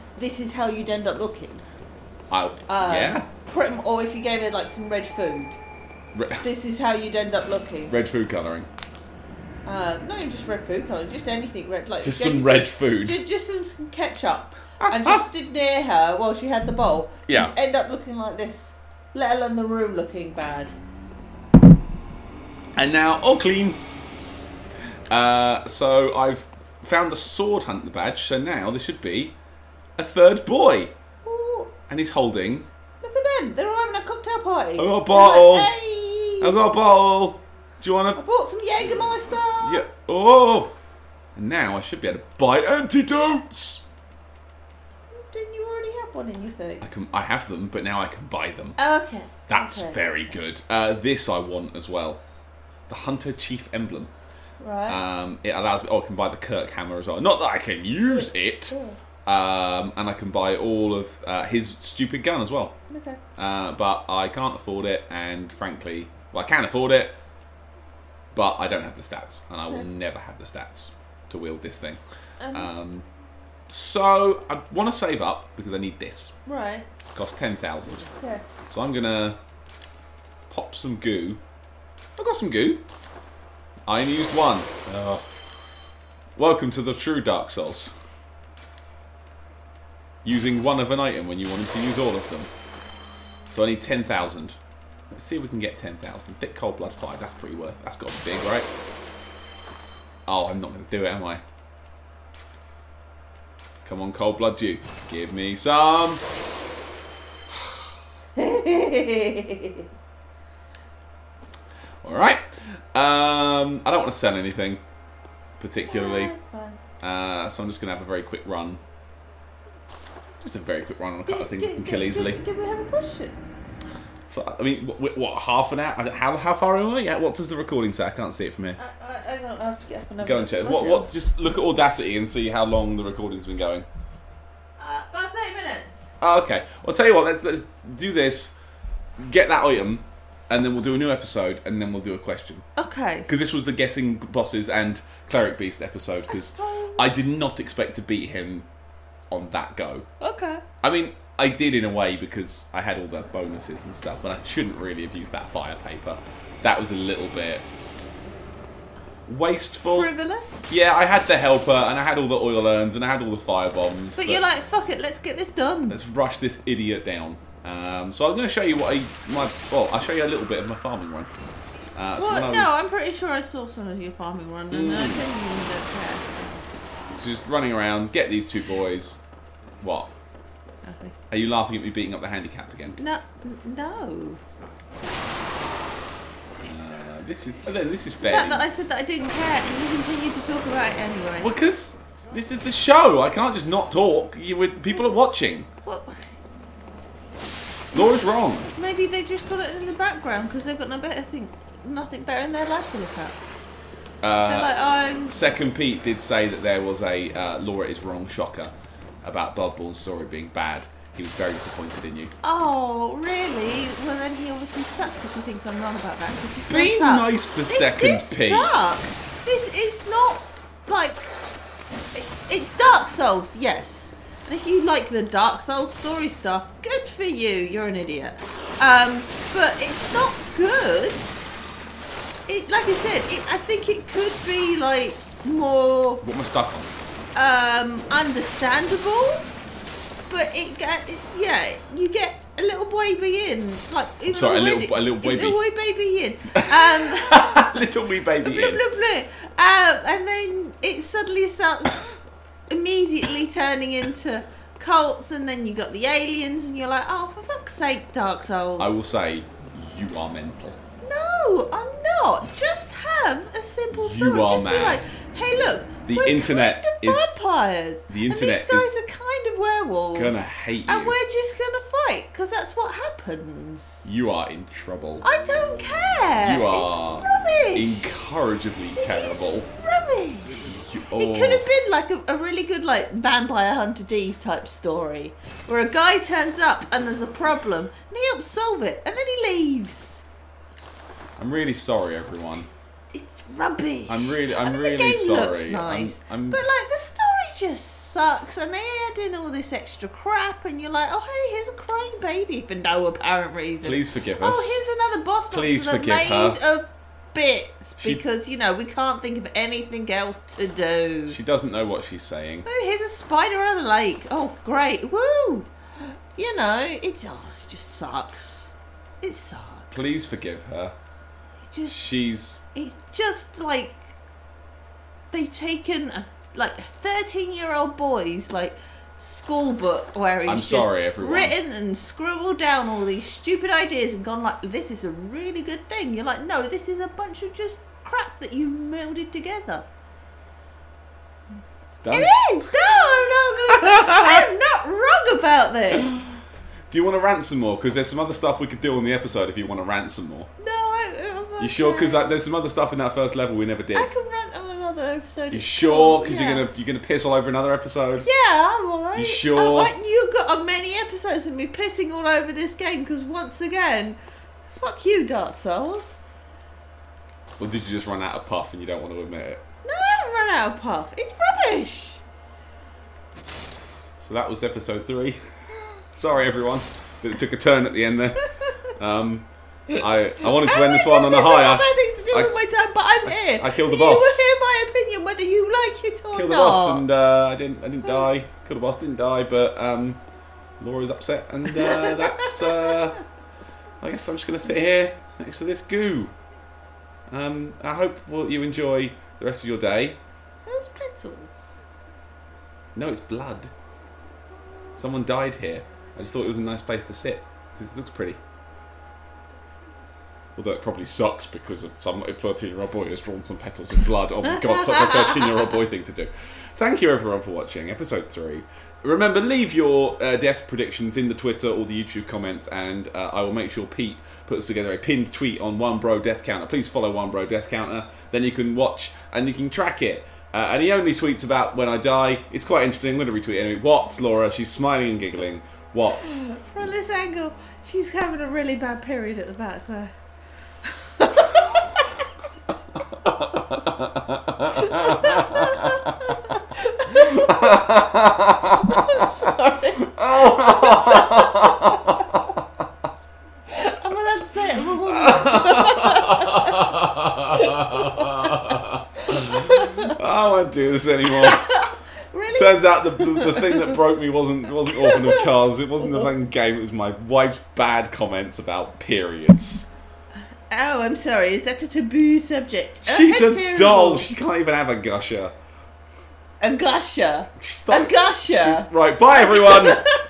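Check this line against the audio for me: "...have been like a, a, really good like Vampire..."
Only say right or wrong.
right.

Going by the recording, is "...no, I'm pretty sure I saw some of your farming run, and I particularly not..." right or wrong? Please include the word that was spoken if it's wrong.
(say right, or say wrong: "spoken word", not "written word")
wrong: "genuinely", not "particularly".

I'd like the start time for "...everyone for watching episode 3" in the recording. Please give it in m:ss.
6:57.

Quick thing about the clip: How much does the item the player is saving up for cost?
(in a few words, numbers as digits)
10,000.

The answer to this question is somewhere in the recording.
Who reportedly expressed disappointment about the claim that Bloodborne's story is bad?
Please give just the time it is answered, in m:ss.
3:25.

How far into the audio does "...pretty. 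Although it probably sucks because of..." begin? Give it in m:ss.
6:48.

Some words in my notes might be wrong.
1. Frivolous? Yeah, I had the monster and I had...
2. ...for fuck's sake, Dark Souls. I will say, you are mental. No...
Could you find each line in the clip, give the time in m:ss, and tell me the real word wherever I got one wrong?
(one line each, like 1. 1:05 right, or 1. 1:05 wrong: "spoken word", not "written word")
1. 2:40 wrong: "helper", not "monster"
2. 4:17 right.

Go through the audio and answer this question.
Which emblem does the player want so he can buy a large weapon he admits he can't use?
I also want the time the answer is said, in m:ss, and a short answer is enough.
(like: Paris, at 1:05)
Hunter Chief emblem, at 0:52.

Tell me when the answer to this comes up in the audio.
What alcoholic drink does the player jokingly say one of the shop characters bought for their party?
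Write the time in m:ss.
0:38.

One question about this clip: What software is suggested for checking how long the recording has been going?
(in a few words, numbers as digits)
Audacity.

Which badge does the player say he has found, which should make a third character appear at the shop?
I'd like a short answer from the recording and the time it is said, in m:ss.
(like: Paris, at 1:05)
Sword Hunter badge, at 0:27.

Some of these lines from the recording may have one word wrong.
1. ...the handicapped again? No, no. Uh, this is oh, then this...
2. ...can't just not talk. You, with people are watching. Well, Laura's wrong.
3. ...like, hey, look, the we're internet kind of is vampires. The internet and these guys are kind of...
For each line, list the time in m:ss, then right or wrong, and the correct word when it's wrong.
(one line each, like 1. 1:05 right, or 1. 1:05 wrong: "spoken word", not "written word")
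1. 3:02 right
2. 3:13 right
3. 4:24 right.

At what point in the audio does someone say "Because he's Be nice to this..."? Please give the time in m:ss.
3:36.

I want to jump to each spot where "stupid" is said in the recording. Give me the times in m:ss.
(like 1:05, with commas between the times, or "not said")
1:01, 5:33.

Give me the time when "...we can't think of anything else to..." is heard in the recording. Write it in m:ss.
5:08.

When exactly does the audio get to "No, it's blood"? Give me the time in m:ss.
6:42.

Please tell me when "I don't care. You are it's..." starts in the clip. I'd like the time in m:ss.
4:35.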